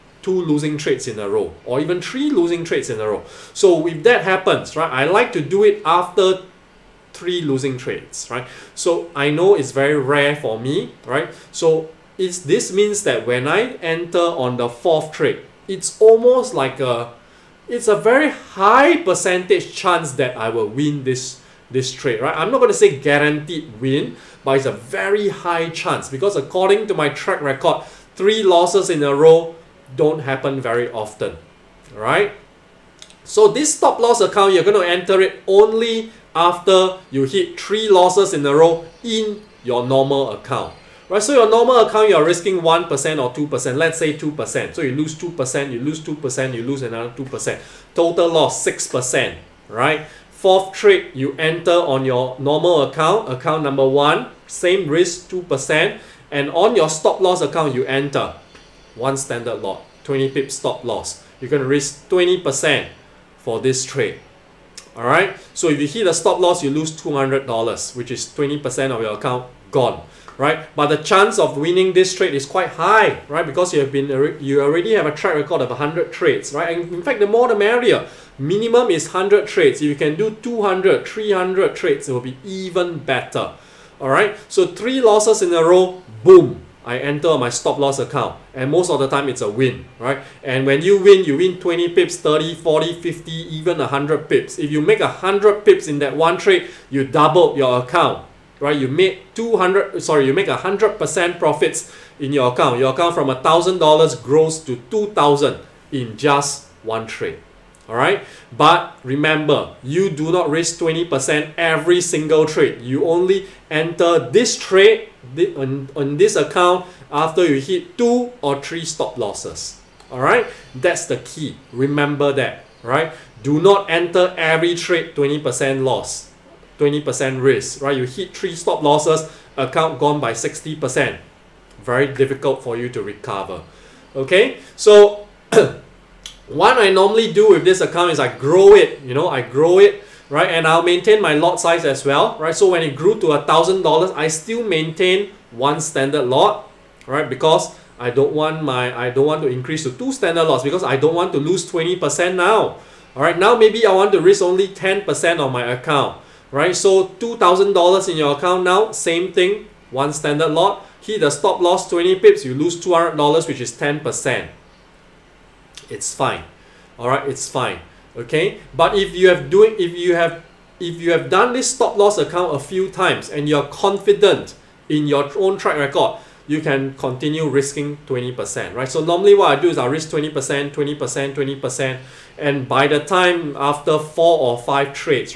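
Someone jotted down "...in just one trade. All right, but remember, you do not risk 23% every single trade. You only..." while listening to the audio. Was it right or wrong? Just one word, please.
wrong.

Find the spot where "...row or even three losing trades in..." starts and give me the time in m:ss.
0:01.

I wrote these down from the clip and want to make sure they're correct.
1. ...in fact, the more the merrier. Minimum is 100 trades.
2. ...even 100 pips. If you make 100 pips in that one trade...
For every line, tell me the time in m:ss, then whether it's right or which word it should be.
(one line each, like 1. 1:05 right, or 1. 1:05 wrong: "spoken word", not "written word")
1. 1:16 right
2. 1:33 right.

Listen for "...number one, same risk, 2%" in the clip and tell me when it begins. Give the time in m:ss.
0:53.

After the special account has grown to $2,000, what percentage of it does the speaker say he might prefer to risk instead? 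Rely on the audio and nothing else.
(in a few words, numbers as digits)
10%.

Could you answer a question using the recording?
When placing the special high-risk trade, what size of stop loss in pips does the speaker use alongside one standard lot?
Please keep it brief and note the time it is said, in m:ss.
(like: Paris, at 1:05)
20 pip, at 1:00.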